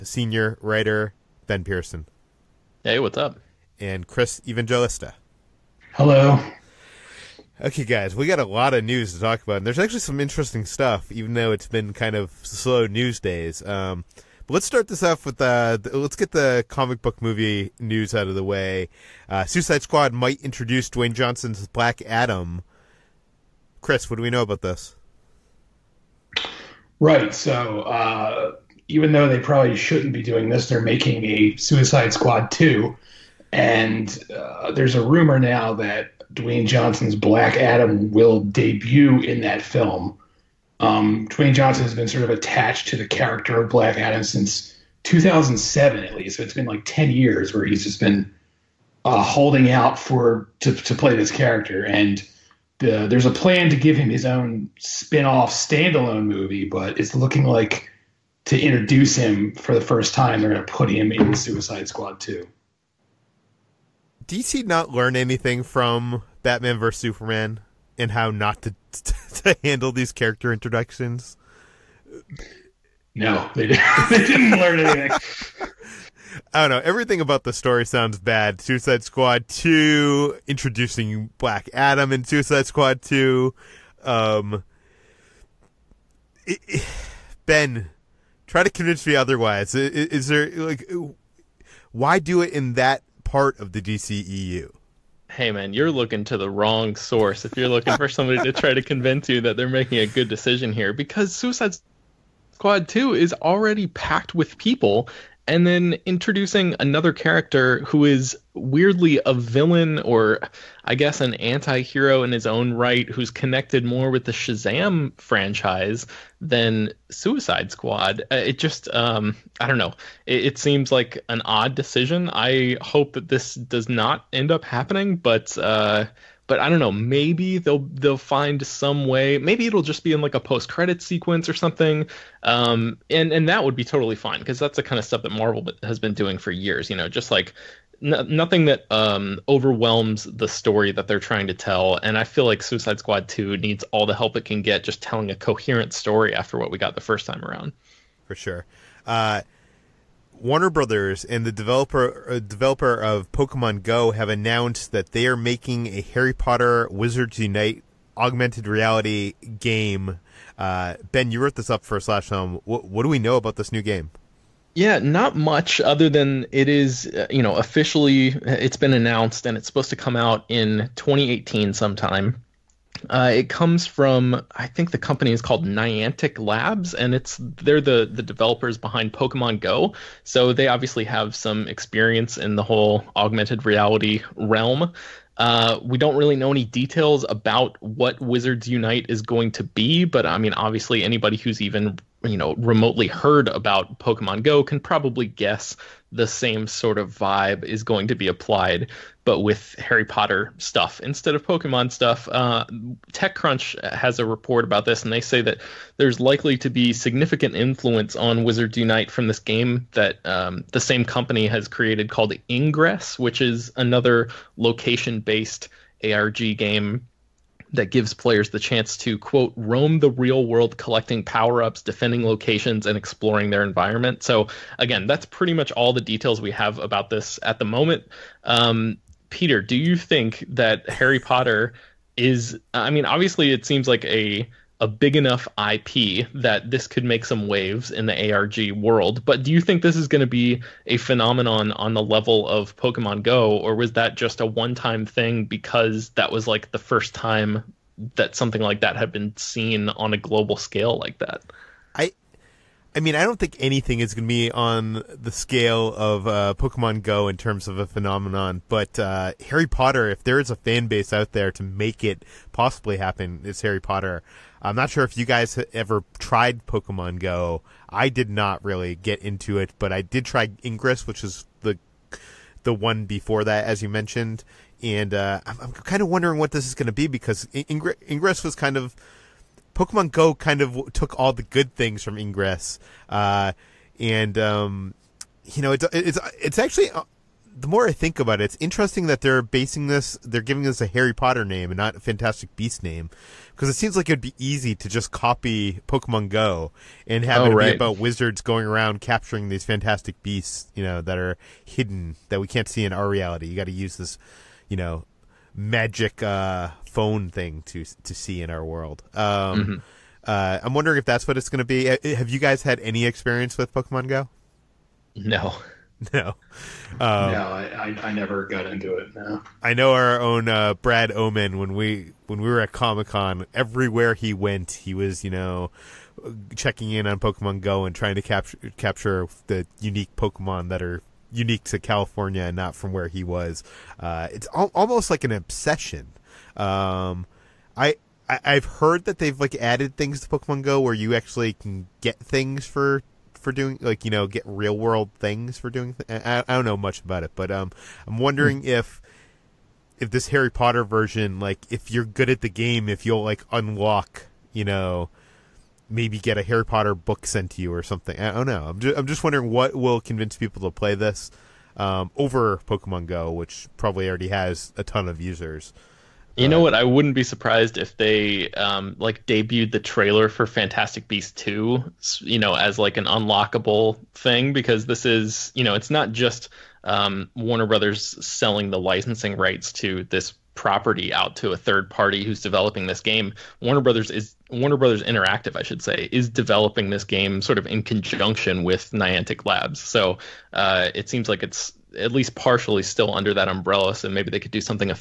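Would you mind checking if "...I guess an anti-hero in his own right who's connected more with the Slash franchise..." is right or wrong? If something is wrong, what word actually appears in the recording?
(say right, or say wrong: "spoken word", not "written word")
wrong: "Shazam", not "Slash".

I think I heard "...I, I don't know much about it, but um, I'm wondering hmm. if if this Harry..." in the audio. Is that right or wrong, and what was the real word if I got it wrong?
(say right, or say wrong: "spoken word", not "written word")
right.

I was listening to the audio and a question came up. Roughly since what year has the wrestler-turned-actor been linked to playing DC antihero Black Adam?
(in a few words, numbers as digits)
2007.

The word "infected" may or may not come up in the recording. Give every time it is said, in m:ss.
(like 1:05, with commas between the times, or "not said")
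not said.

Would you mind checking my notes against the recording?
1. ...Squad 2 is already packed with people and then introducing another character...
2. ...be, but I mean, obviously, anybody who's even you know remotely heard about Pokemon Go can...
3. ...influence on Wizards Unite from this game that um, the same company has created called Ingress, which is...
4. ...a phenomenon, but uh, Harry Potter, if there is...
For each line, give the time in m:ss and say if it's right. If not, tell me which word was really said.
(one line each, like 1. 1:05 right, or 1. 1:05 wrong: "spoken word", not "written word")
1. 1:42 right
2. 3:09 right
3. 3:27 right
4. 4:17 right.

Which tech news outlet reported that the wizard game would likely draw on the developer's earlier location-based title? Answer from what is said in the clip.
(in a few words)
TechCrunch.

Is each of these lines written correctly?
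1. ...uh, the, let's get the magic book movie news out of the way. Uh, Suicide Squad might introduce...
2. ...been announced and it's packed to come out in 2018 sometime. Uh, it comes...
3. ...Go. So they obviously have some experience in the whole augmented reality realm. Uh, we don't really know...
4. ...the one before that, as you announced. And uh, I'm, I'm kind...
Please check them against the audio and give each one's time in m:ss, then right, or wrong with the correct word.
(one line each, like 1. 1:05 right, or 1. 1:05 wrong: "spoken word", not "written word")
1. 0:15 wrong: "comic", not "magic"
2. 2:48 wrong: "supposed", not "packed"
3. 2:59 right
4. 4:32 wrong: "mentioned", not "announced".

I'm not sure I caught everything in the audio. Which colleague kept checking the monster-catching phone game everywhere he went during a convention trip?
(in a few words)
Brad Omen.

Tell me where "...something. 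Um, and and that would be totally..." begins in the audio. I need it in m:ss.
2:11.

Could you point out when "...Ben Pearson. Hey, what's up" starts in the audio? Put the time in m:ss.
0:01.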